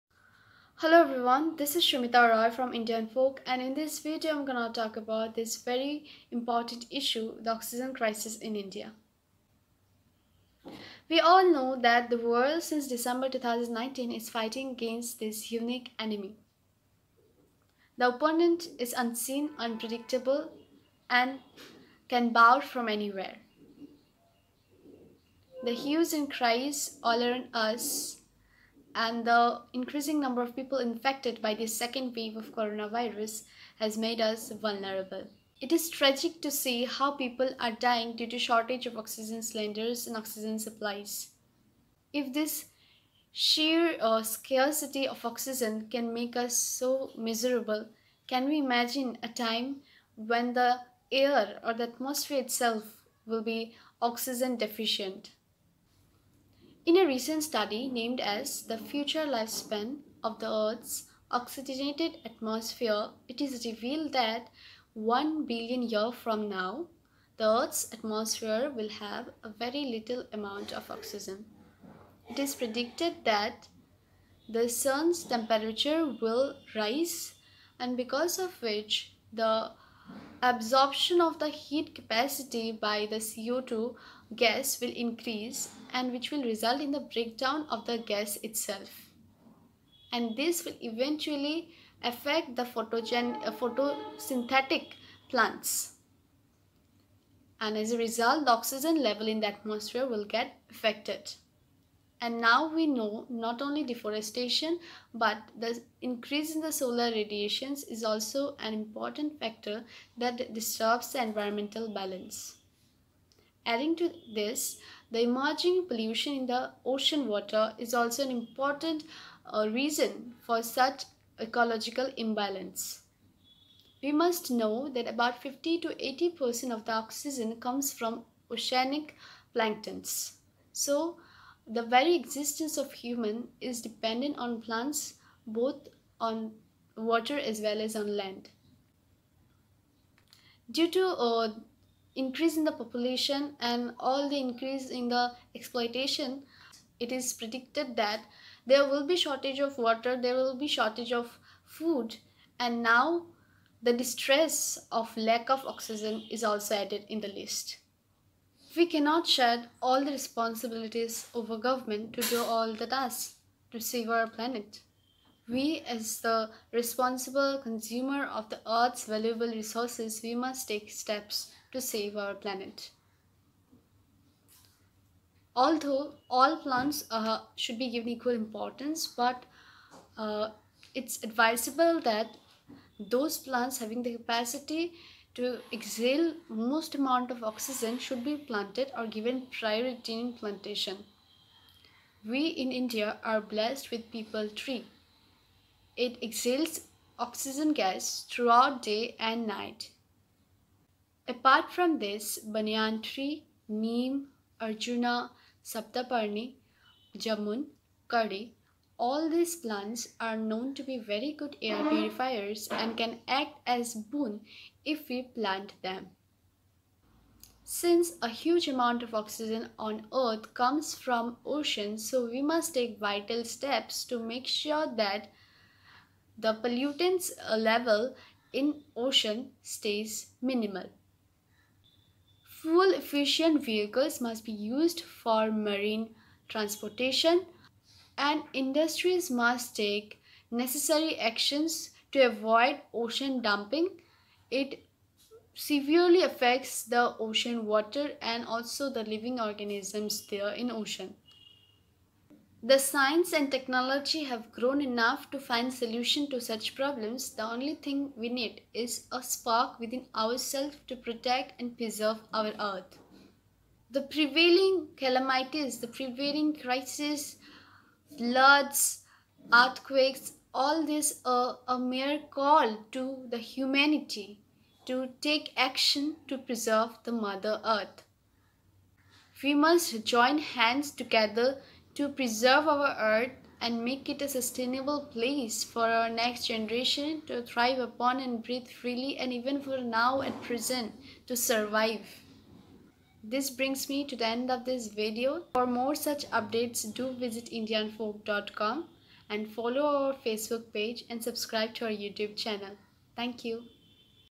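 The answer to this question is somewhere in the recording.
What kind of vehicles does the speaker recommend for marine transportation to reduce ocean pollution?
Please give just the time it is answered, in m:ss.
3:52.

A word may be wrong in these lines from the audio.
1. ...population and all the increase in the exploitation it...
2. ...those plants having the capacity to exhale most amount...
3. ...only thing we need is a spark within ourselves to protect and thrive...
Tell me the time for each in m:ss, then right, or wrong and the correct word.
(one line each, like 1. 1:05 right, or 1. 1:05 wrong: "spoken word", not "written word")
1. 2:22 right
2. 3:03 right
3. 4:17 wrong: "preserve", not "thrive".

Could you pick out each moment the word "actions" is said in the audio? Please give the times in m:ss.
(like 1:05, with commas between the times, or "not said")
4:01, 4:35.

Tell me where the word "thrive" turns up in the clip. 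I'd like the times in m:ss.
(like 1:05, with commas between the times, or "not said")
4:47.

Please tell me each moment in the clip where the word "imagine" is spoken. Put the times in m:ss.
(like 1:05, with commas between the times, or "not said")
0:48.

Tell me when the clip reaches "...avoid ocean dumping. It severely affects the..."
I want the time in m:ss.
4:02.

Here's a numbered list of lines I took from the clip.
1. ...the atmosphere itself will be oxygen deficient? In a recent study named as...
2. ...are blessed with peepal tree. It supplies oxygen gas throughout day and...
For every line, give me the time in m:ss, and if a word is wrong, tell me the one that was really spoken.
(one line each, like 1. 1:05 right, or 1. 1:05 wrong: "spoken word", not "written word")
1. 0:51 right
2. 3:13 wrong: "exhales", not "supplies".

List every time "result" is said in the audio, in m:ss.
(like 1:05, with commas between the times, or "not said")
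1:26, 1:37.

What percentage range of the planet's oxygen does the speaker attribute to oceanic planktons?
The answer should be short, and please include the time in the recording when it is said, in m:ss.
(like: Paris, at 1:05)
50 to 80%, at 2:05.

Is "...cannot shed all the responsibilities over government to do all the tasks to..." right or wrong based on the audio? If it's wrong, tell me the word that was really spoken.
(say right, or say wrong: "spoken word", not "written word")
right.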